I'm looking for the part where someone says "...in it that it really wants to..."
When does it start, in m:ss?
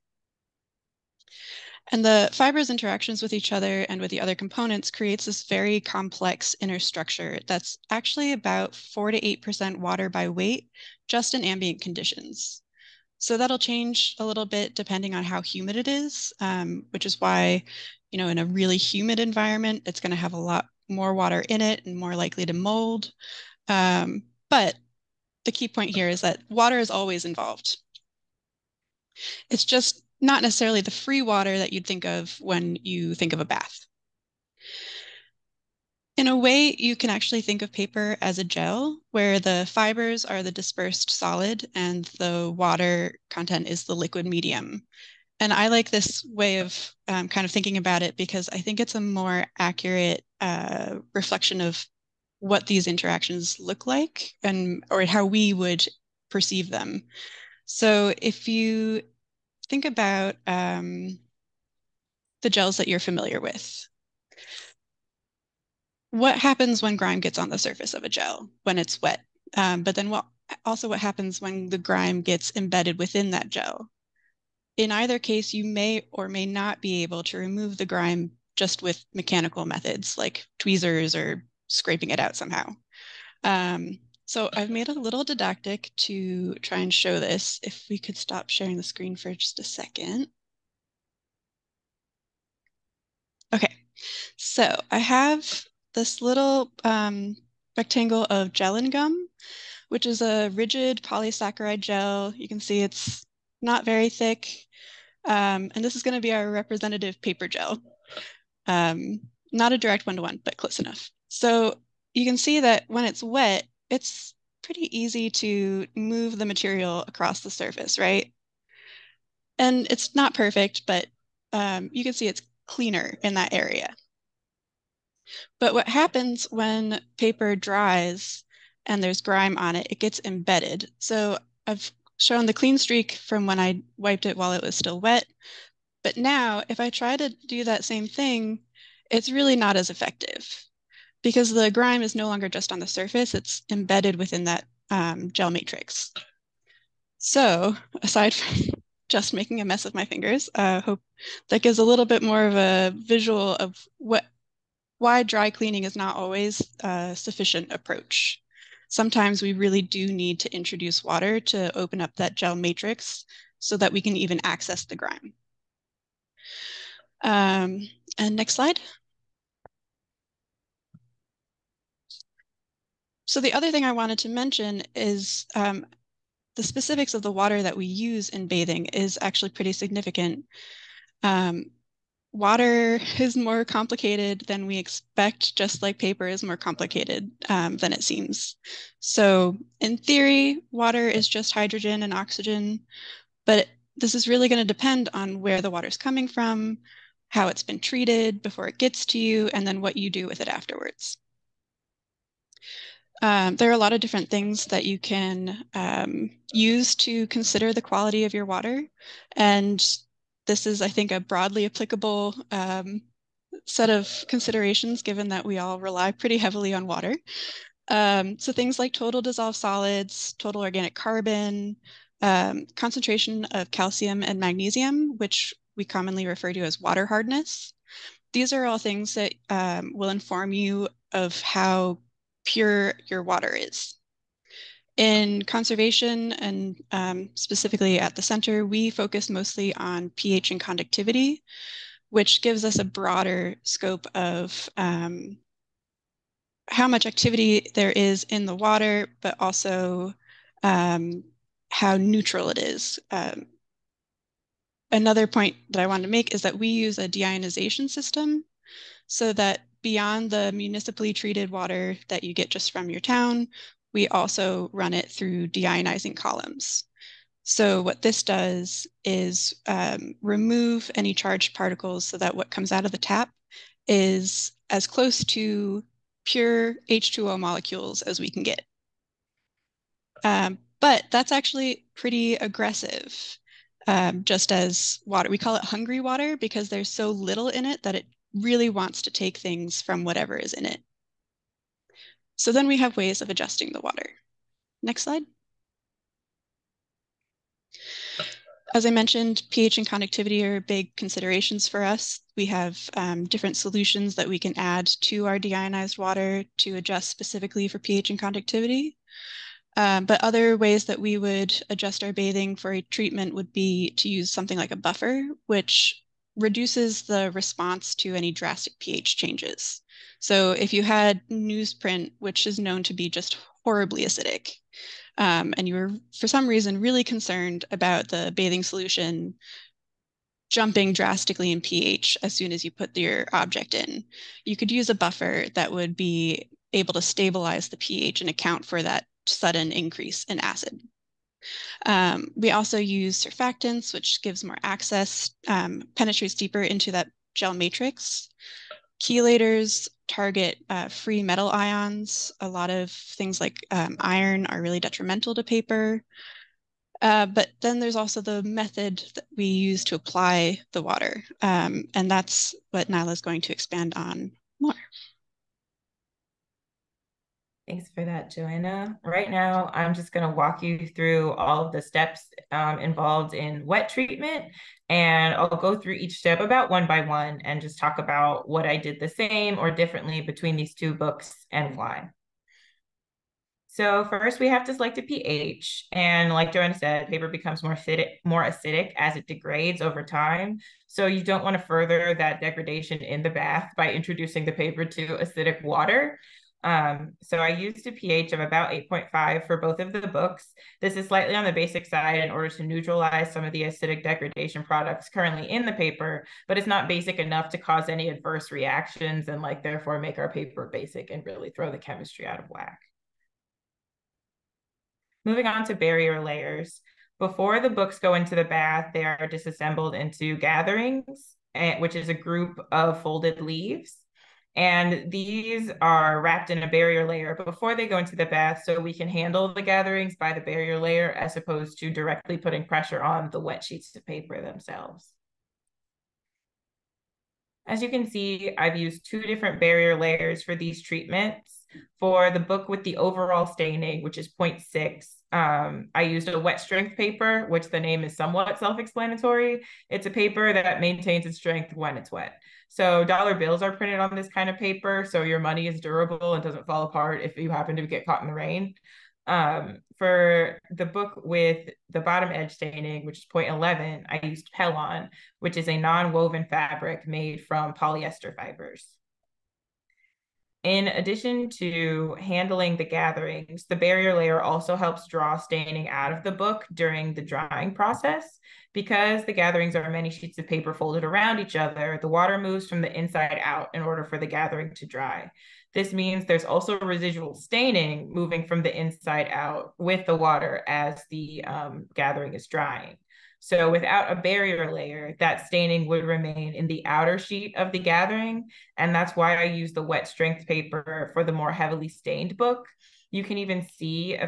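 4:47.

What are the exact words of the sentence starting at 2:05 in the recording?
But what happens when paper dries and there's grime on it, it gets embedded.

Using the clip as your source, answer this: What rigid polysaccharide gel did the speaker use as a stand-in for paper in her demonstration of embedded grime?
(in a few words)
gellan gum.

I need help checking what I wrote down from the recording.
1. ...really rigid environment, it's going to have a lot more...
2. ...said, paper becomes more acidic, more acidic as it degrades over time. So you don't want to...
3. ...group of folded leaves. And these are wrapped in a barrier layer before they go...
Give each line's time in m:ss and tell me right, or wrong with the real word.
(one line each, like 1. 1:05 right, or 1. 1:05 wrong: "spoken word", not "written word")
1. 0:18 wrong: "humid", not "rigid"
2. 6:26 right
3. 7:02 right.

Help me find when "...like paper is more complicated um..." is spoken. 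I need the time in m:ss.
3:05.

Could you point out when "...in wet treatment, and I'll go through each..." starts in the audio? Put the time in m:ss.
6:13.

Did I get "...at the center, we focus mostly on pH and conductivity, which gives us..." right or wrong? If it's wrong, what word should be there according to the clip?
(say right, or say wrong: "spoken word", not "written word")
right.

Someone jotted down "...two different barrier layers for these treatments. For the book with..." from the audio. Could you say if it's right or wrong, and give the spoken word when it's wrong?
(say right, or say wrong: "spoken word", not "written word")
right.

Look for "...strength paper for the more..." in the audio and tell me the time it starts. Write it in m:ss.
8:20.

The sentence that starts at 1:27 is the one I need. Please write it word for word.
If we could stop sharing the screen for just a second.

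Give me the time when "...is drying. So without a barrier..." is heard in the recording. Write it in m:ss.
8:12.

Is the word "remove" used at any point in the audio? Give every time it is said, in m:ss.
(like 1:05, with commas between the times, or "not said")
1:17, 4:30.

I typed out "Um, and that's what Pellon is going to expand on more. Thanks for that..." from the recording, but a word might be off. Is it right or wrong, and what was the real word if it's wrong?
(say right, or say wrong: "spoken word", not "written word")
wrong: "Nylah", not "Pellon".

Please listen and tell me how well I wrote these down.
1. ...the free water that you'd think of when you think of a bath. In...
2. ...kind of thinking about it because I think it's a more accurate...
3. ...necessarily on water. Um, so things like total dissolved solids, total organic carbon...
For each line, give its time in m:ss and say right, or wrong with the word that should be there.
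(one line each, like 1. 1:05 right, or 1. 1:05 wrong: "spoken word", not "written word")
1. 0:30 right
2. 0:47 right
3. 3:36 wrong: "heavily", not "necessarily".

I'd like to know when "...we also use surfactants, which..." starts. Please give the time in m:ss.
5:42.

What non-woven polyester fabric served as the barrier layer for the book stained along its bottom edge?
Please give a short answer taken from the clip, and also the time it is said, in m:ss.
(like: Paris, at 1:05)
Pellon, at 7:44.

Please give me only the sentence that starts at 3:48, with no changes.
These are all things that um, will inform you of how pure your water is.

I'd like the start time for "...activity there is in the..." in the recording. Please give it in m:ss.
4:07.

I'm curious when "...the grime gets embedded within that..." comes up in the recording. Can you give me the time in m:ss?
1:11.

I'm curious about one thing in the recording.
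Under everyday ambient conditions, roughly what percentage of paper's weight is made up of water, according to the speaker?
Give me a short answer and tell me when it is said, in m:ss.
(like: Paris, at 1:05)
4 to 8%, at 0:08.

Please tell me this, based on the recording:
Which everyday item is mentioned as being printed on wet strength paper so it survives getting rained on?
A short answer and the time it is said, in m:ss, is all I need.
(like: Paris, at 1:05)
dollar bills, at 7:33.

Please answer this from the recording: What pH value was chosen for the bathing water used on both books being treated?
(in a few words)
8.5.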